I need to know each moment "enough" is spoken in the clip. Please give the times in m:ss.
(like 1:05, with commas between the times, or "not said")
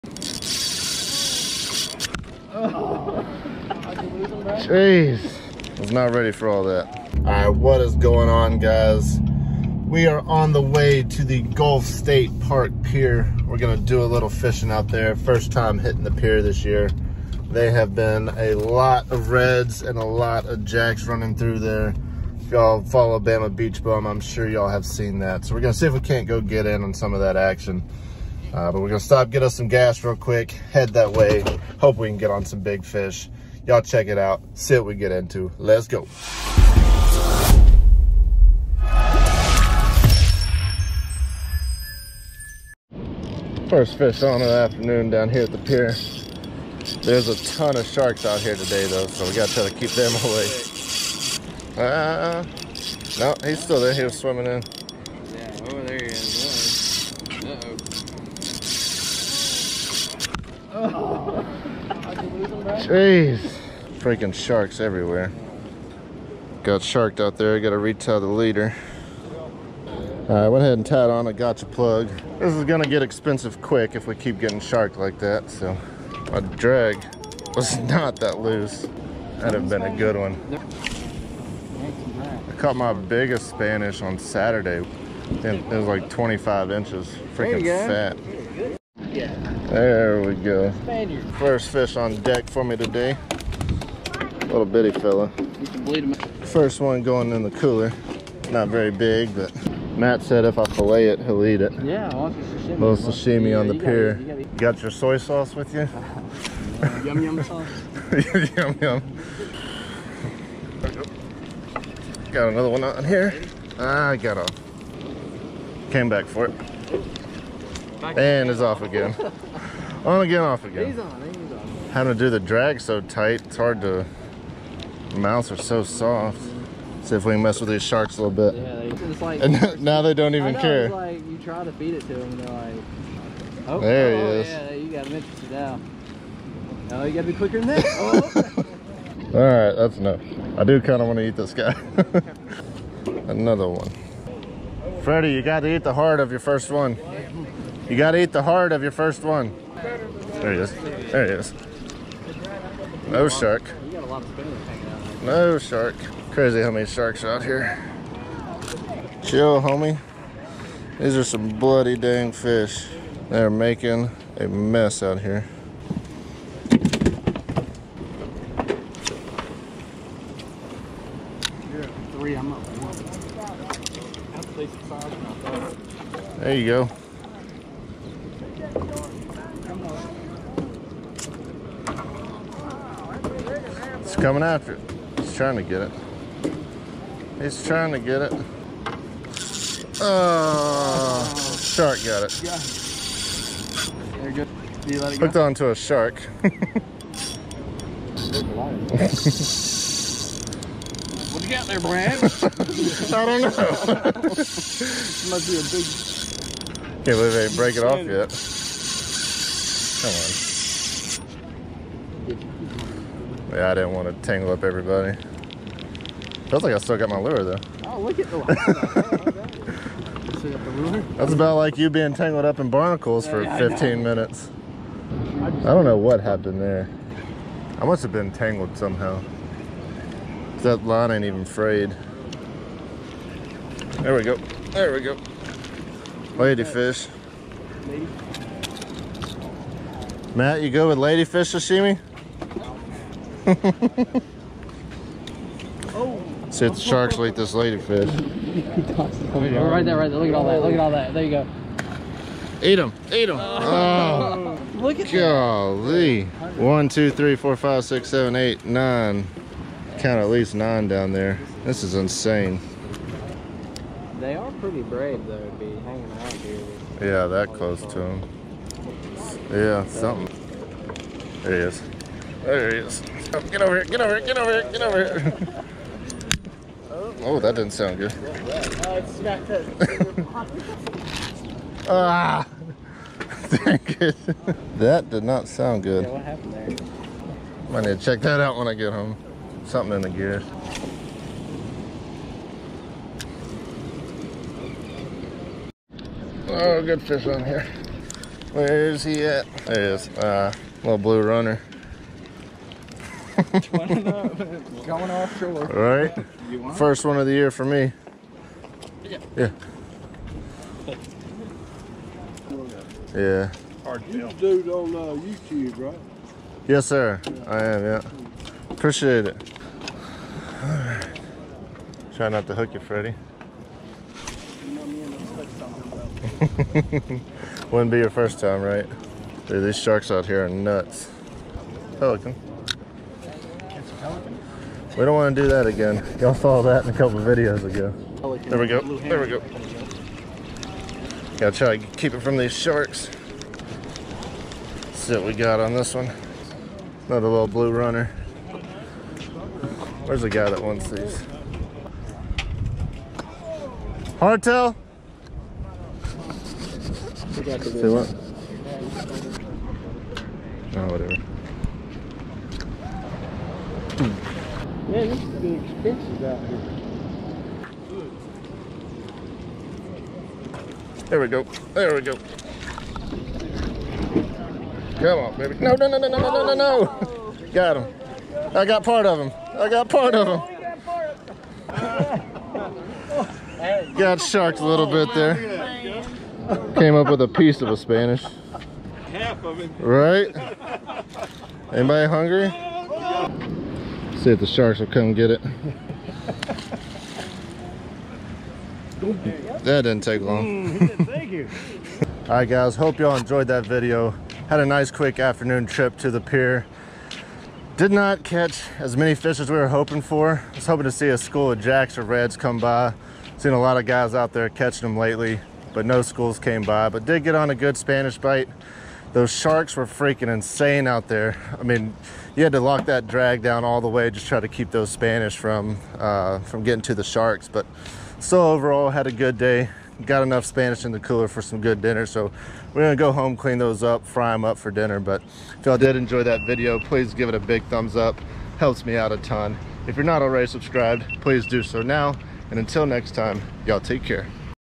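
2:19, 7:10.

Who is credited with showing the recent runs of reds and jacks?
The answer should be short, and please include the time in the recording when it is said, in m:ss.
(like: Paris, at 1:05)
Bama Beach Bum, at 0:23.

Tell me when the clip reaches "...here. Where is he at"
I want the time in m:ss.
4:57.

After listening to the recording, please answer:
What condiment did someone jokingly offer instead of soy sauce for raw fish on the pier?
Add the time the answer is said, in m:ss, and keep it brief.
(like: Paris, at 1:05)
yum yum sauce, at 1:47.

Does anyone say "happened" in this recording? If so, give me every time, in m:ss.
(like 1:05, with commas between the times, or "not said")
3:46, 4:46.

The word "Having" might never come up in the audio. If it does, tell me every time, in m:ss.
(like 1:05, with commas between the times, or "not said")
2:01.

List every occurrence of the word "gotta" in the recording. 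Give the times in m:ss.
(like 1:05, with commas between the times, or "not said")
0:49, 2:17, 2:27, 5:41.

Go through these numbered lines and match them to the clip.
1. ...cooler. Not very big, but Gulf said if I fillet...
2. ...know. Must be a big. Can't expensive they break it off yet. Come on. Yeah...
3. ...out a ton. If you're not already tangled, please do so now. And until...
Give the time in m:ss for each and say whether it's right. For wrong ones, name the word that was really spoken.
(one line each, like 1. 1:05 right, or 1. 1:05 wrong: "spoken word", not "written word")
1. 1:37 wrong: "Matt", not "Gulf"
2. 3:23 wrong: "believe", not "expensive"
3. 7:18 wrong: "subscribed", not "tangled".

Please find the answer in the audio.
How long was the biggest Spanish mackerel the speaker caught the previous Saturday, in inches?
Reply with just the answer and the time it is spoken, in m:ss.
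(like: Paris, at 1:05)
25 inches, at 1:26.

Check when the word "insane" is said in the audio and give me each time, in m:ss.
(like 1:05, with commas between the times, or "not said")
4:21, 7:00.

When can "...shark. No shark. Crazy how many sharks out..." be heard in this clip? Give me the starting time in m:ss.
2:33.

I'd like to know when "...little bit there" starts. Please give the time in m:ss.
6:24.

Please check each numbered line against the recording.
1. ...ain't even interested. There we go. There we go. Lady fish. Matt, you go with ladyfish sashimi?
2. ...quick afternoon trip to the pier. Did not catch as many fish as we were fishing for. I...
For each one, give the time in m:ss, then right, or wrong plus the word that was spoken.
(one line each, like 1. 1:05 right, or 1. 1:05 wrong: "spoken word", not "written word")
1. 3:51 wrong: "frayed", not "interested"
2. 6:44 wrong: "hoping", not "fishing".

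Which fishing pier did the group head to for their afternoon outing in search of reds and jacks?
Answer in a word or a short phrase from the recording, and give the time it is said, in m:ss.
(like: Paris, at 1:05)
Gulf State Park Pier, at 0:11.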